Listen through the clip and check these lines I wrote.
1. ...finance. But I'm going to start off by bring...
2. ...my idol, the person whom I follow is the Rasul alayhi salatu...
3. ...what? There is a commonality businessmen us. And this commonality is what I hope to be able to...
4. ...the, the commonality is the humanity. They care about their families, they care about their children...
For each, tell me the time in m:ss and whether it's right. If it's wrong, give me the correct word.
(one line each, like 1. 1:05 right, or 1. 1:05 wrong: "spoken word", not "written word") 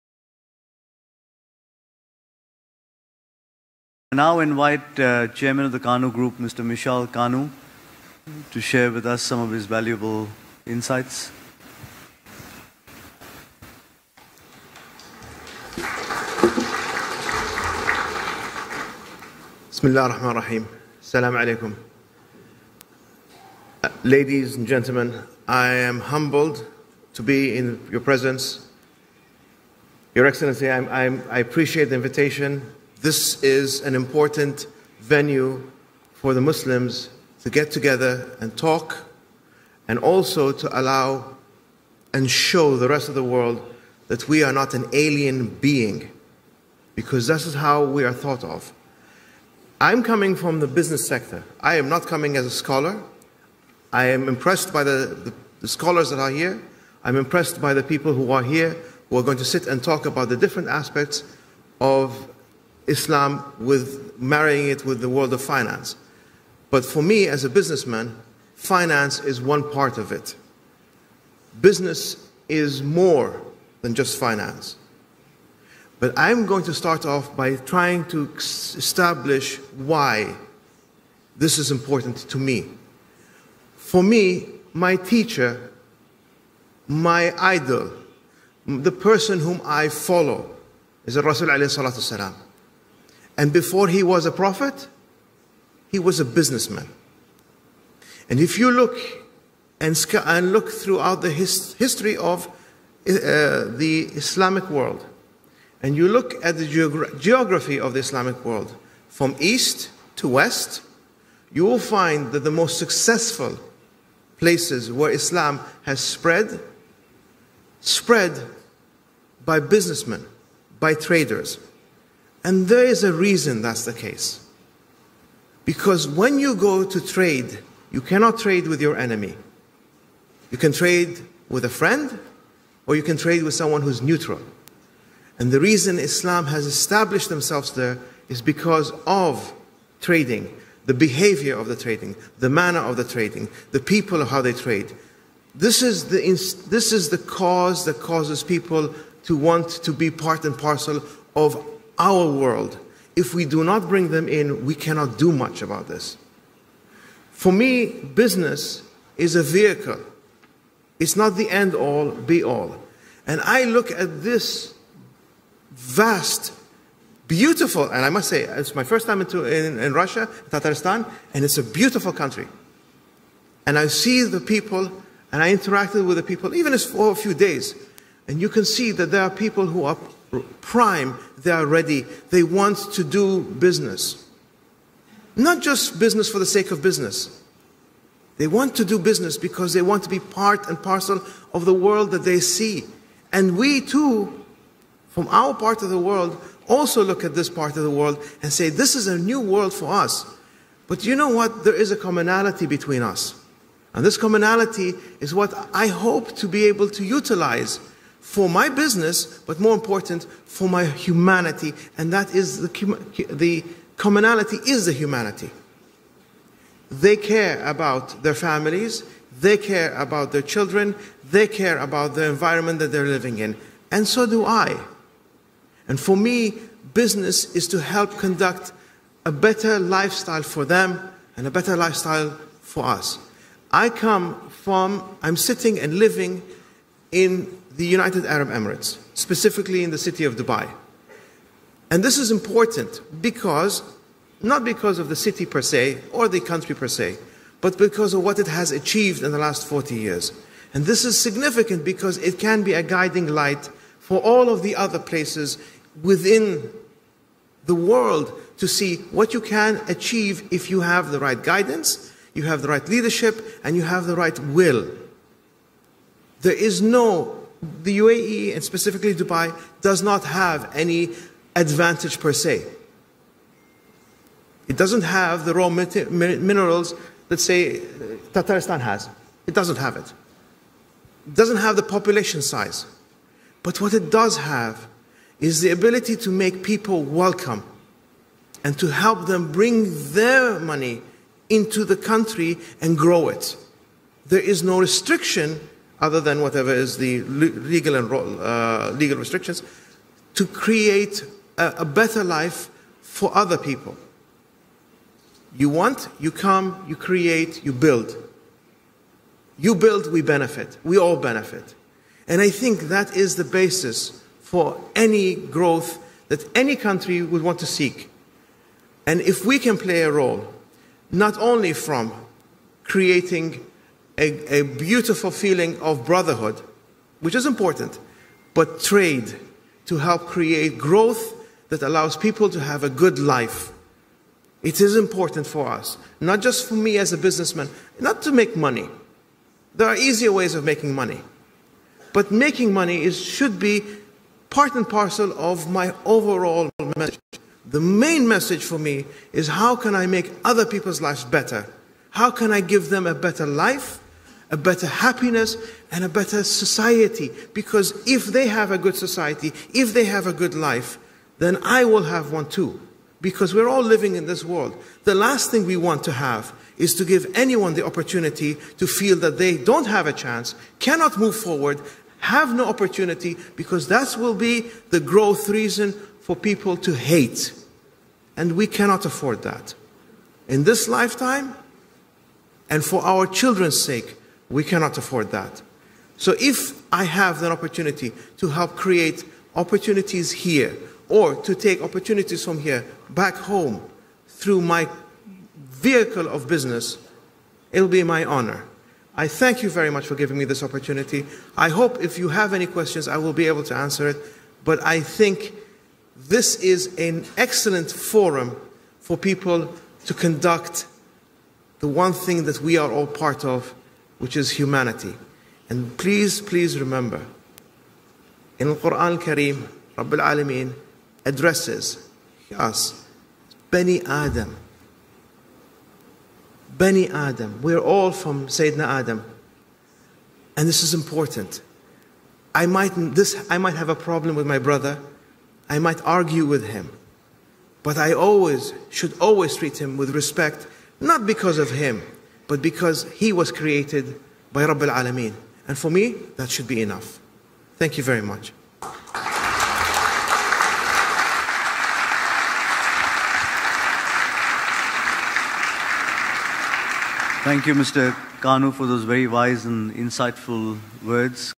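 1. 1:14 wrong: "trying", not "bring"
2. 1:26 right
3. 3:21 wrong: "between", not "businessmen"
4. 3:32 right.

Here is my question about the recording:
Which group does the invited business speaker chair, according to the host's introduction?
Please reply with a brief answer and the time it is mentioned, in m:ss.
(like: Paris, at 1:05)
Kanoo Group, at 0:05.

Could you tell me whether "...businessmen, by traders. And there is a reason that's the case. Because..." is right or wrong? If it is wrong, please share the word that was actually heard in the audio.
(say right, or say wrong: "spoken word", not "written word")
right.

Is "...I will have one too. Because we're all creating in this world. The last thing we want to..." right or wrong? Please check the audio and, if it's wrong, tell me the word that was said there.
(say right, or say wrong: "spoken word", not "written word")
wrong: "living", not "creating".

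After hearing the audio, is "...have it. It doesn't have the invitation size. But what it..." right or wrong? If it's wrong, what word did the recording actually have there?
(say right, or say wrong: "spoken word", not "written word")
wrong: "population", not "invitation".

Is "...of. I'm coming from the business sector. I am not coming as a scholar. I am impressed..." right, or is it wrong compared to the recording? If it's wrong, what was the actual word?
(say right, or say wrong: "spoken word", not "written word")
right.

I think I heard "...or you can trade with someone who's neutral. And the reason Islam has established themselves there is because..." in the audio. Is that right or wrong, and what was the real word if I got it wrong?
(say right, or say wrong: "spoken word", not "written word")
right.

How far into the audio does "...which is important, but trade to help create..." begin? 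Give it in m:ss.
5:27.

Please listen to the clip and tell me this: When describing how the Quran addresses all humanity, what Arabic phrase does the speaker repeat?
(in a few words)
Bani Adam.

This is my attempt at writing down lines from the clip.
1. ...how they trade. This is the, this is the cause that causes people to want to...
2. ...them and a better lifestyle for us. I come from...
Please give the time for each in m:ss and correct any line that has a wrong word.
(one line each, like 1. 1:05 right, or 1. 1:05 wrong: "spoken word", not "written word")
1. 2:24 right
2. 3:50 right.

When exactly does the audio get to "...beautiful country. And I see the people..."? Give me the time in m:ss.
2:51.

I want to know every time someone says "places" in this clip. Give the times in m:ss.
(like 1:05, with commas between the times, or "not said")
1:54, 4:14.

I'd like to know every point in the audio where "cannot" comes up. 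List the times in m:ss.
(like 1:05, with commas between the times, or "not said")
2:08, 2:34, 6:10, 6:18, 6:24.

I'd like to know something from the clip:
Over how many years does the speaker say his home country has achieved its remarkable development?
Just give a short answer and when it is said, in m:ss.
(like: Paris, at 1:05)
40, at 4:09.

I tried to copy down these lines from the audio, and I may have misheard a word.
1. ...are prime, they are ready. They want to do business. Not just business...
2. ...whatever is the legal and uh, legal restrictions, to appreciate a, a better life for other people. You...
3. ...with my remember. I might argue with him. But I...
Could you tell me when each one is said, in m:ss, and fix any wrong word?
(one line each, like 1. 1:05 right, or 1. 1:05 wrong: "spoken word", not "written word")
1. 2:59 right
2. 4:56 wrong: "create", not "appreciate"
3. 7:14 wrong: "brother", not "remember".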